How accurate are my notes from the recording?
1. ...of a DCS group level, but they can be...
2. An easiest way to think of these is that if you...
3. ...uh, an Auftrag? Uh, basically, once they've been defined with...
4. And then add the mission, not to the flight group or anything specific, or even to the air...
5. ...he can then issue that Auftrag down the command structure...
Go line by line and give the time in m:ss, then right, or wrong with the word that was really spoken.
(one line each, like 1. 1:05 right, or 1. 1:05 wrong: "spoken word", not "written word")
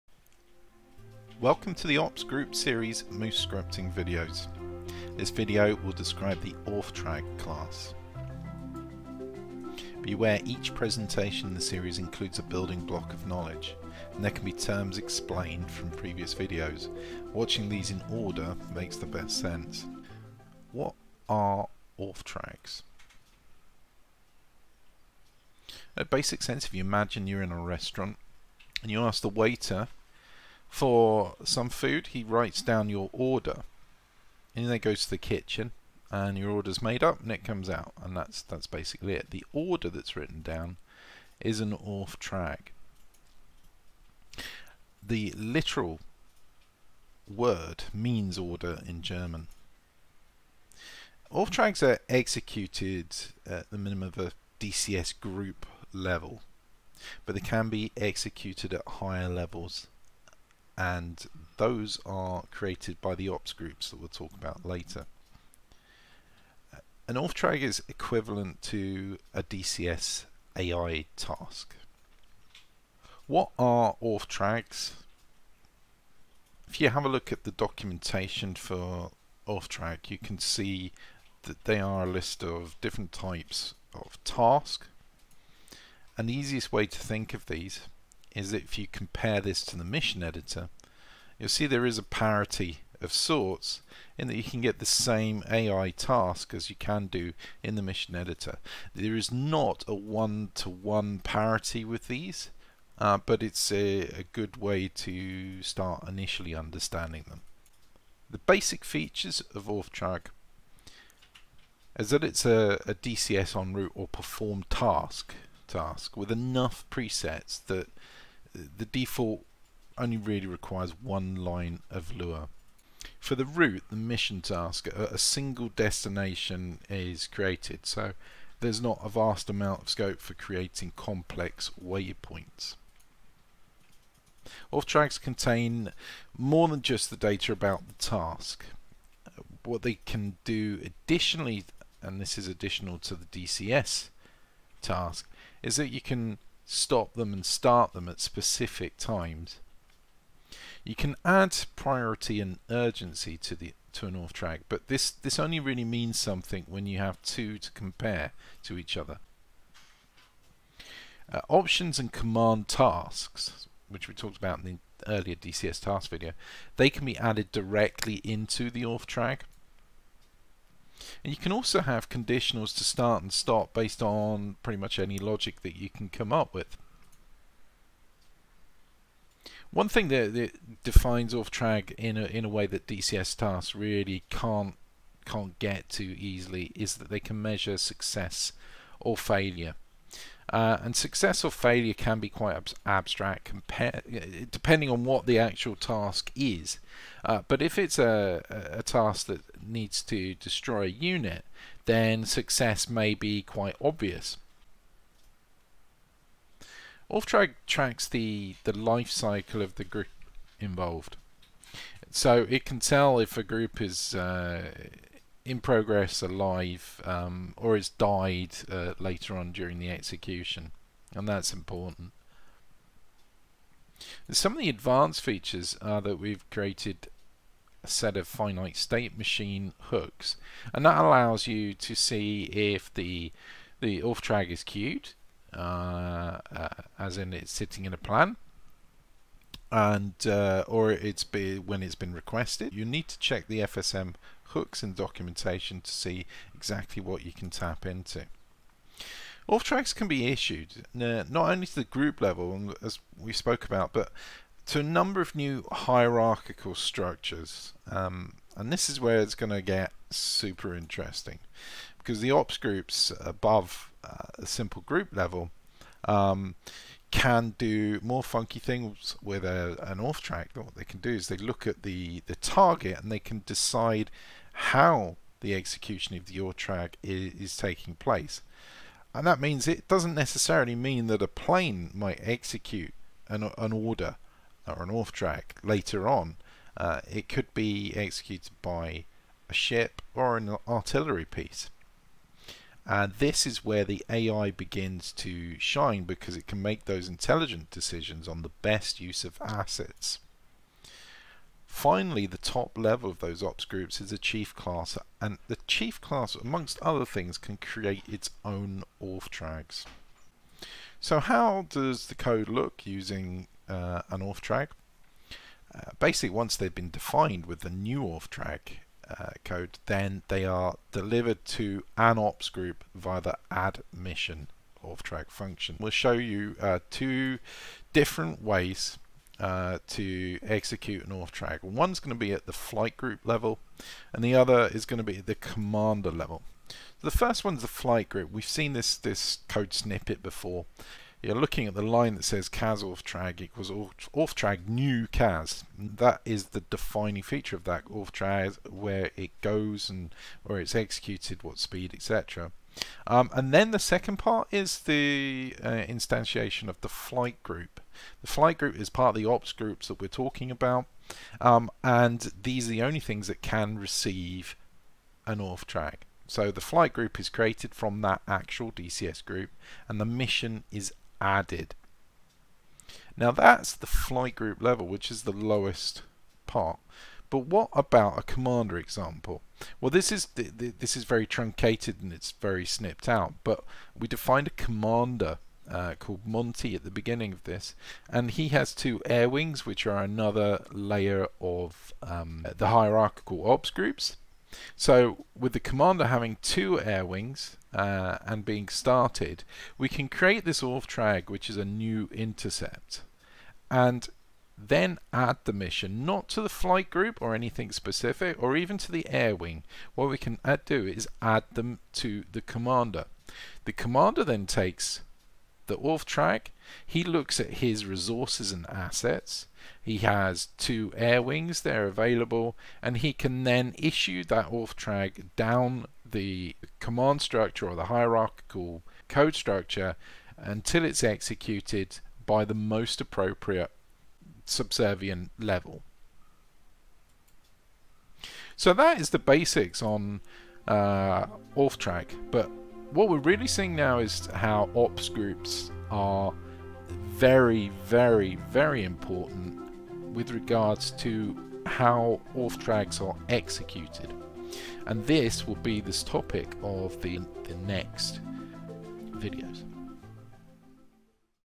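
1. 0:54 right
2. 1:26 right
3. 5:13 right
4. 6:43 right
5. 7:02 right.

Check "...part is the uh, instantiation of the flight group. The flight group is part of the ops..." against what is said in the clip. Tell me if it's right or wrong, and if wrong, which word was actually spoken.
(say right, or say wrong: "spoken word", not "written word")
right.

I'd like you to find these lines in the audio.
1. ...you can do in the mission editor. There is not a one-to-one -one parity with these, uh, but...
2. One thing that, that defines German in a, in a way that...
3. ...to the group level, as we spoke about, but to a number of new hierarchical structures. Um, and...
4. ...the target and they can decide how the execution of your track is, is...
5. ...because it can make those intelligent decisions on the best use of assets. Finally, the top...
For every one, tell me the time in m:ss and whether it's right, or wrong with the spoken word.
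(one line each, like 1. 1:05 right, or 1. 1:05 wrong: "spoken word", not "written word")
1. 1:36 right
2. 2:59 wrong: "Auftrag", not "German"
3. 4:11 right
4. 4:32 right
5. 4:56 right.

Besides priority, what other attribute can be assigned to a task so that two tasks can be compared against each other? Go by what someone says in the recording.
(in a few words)
Urgency.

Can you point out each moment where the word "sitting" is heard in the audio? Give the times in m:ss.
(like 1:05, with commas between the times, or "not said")
3:57.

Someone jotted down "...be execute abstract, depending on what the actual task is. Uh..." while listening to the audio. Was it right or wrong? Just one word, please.
wrong.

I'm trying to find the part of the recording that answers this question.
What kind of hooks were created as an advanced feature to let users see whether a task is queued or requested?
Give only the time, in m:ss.
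3:48.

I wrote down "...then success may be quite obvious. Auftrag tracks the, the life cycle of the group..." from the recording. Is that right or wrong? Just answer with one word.
right.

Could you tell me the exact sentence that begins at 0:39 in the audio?
The order that's written down is an Auftrag.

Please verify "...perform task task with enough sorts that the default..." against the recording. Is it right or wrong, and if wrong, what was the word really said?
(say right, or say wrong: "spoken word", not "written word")
wrong: "presets", not "sorts".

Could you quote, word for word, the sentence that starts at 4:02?
You need to check the FSM hooks and documentation to see exactly what you can tap into.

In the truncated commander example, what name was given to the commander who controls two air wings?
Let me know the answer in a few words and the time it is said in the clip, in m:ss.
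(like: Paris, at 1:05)
Monty, at 6:26.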